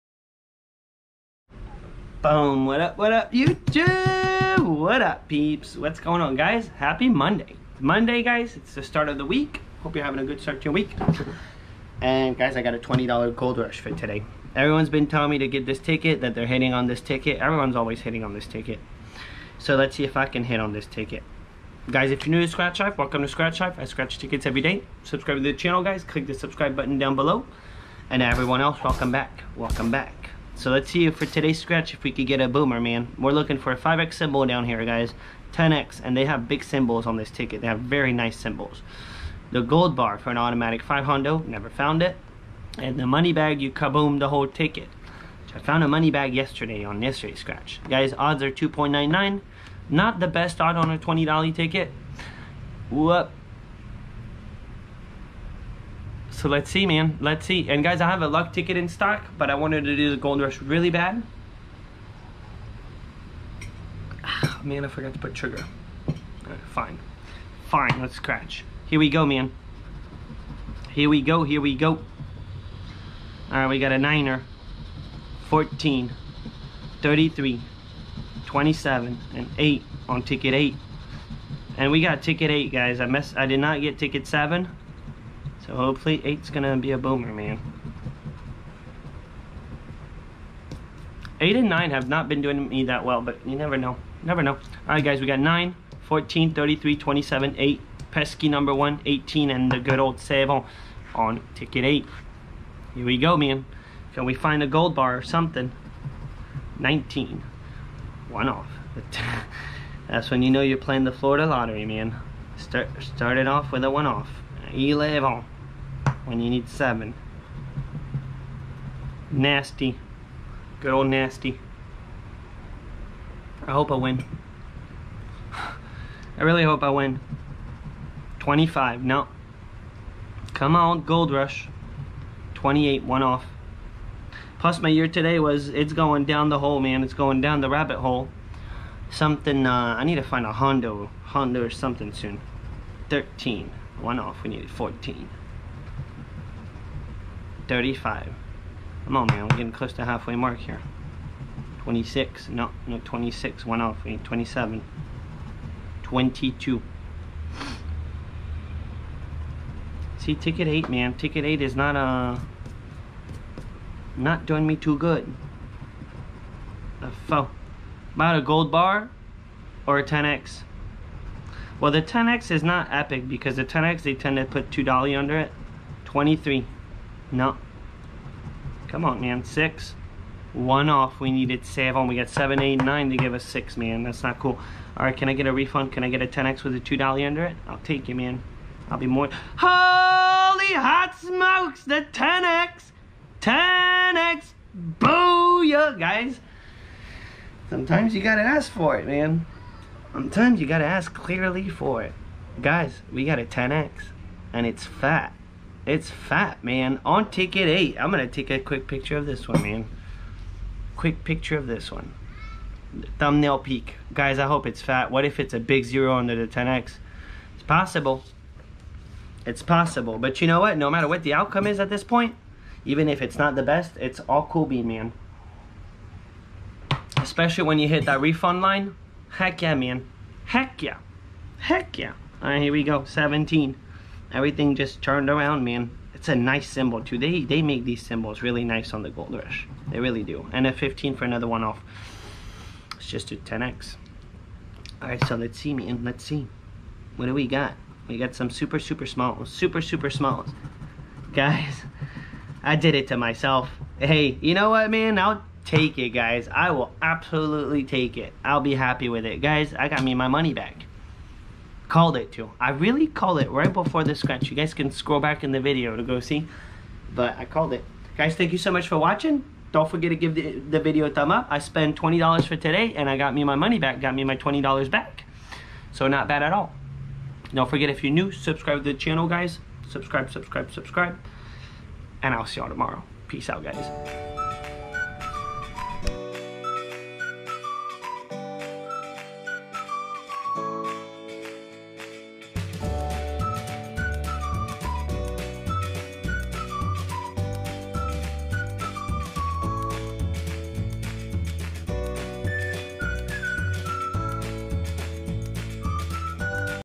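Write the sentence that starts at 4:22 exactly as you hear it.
I really called it right before the scratch.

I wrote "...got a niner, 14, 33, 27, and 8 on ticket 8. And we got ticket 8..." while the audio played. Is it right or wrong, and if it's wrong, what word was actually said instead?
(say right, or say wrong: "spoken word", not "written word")
right.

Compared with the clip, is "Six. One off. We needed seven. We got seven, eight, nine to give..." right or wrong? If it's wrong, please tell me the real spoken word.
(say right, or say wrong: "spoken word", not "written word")
right.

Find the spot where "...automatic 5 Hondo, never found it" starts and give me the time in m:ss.
0:40.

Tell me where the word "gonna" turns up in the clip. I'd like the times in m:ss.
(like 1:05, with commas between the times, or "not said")
1:26, 3:28.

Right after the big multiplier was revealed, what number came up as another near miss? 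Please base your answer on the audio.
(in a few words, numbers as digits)
15.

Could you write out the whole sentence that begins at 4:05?
All right, so let's see, man.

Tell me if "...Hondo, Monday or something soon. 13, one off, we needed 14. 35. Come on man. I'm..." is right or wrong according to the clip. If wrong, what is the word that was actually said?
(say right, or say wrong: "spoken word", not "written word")
wrong: "Hondo", not "Monday".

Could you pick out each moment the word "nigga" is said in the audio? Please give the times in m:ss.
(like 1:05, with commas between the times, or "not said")
not said.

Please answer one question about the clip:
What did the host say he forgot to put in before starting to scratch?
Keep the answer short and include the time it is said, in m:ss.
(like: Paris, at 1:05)
sugar, at 1:05.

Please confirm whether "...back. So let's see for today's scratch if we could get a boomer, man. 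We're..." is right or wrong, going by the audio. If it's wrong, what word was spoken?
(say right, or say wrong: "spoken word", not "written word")
right.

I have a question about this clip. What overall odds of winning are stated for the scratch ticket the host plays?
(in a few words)
2.99.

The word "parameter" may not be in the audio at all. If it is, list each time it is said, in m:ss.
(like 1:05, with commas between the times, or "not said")
not said.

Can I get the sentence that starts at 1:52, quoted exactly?
Start, started off with a one off.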